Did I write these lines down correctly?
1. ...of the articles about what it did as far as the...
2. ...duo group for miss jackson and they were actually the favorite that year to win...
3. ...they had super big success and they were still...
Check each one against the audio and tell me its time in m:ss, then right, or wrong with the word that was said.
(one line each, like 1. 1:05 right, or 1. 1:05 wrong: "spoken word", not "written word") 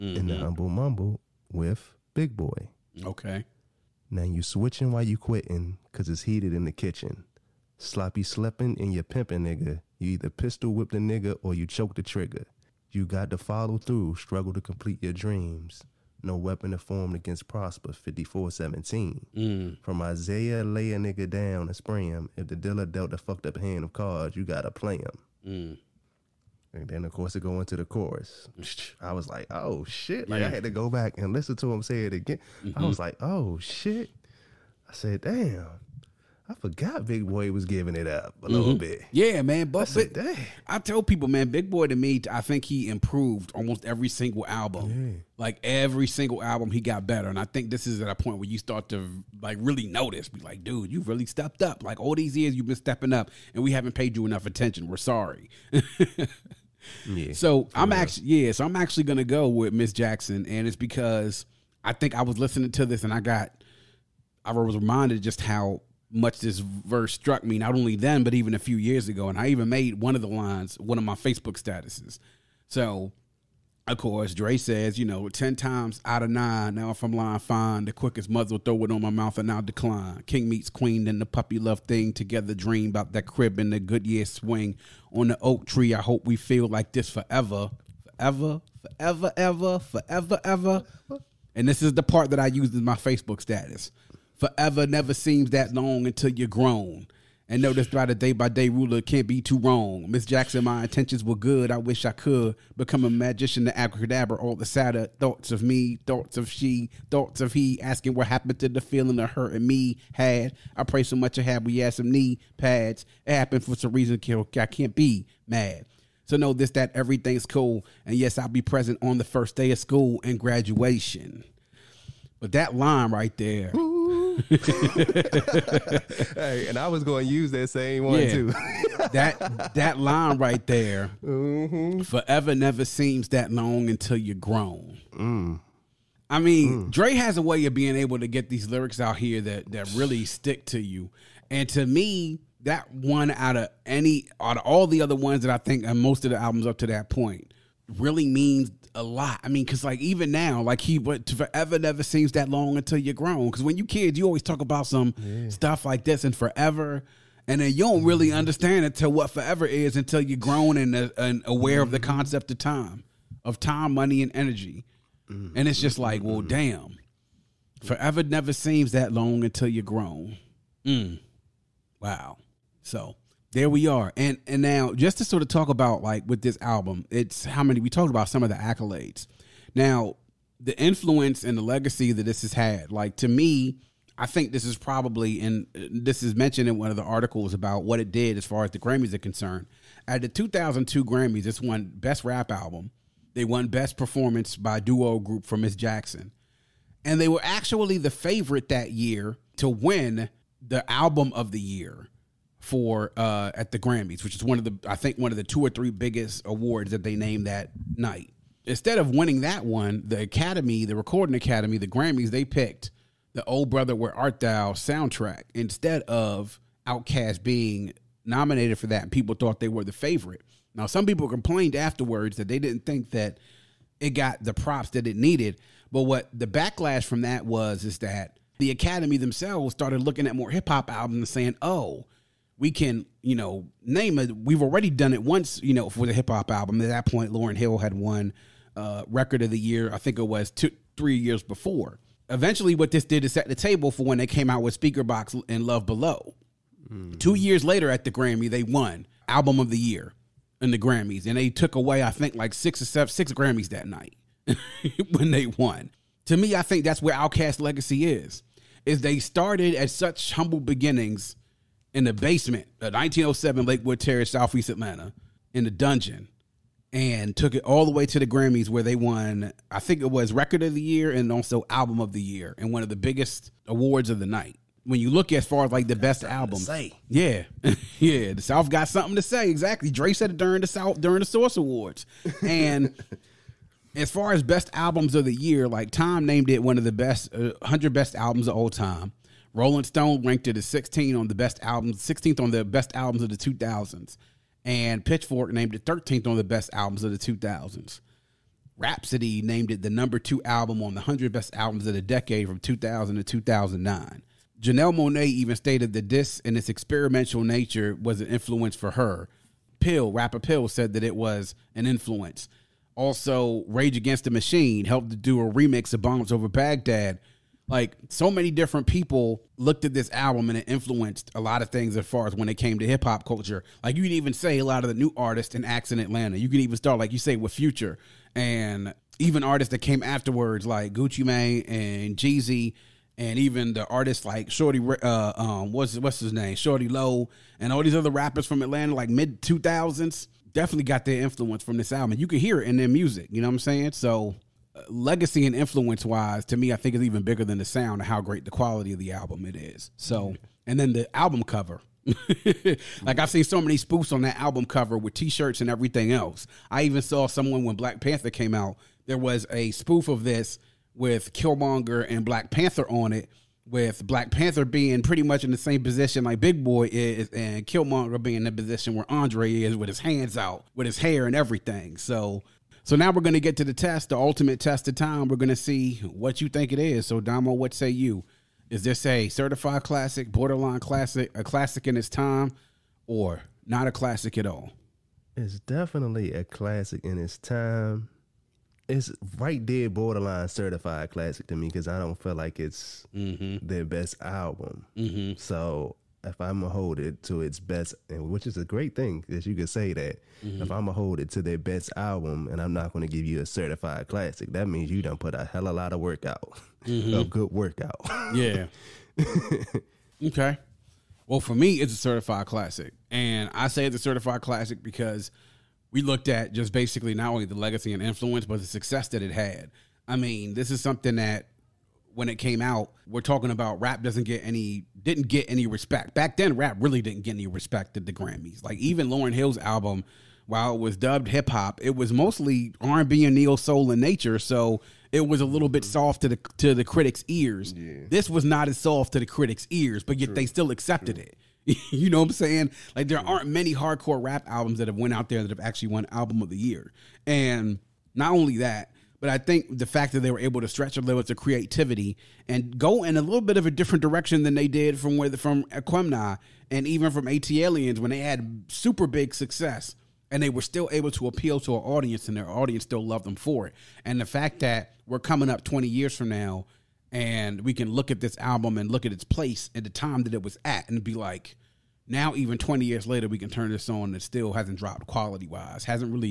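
1. 3:06 right
2. 3:14 right
3. 7:38 right.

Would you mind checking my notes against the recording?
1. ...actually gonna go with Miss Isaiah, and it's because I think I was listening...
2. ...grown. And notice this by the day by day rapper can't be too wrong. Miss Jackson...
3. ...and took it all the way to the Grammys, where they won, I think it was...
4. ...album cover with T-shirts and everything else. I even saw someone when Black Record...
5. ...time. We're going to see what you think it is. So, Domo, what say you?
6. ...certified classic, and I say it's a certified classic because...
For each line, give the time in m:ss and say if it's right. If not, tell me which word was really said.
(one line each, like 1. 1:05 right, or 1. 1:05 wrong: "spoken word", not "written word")
1. 0:58 wrong: "Jackson", not "Isaiah"
2. 1:36 wrong: "ruler", not "rapper"
3. 4:26 right
4. 5:54 wrong: "Panther", not "Record"
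5. 6:14 right
6. 6:51 right.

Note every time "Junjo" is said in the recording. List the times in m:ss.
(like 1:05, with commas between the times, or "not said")
not said.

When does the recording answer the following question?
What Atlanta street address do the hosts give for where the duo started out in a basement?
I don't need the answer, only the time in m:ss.
4:22.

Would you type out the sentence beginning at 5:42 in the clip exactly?
You can hear it in their music.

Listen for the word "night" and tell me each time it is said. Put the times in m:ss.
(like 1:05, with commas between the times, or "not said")
3:27, 4:13, 4:34.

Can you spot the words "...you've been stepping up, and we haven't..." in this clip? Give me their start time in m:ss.
0:52.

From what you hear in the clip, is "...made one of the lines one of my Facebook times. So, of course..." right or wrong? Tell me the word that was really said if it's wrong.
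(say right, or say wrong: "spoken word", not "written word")
wrong: "statuses", not "times".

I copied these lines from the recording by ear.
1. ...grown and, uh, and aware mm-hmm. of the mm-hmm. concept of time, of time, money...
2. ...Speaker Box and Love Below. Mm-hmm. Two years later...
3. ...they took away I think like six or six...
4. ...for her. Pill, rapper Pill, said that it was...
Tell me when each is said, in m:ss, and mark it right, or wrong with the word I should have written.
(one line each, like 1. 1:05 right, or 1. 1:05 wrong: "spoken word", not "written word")
1. 2:40 right
2. 4:04 right
3. 4:11 wrong: "seven", not "six"
4. 5:08 right.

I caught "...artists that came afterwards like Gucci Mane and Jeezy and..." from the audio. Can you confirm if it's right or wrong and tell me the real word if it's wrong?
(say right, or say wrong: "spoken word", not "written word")
right.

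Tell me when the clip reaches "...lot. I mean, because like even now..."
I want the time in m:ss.
2:29.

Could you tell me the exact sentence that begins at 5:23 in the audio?
Like you can even say a lot of the new artists and acts in Atlanta.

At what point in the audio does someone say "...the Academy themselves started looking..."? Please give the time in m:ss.
3:48.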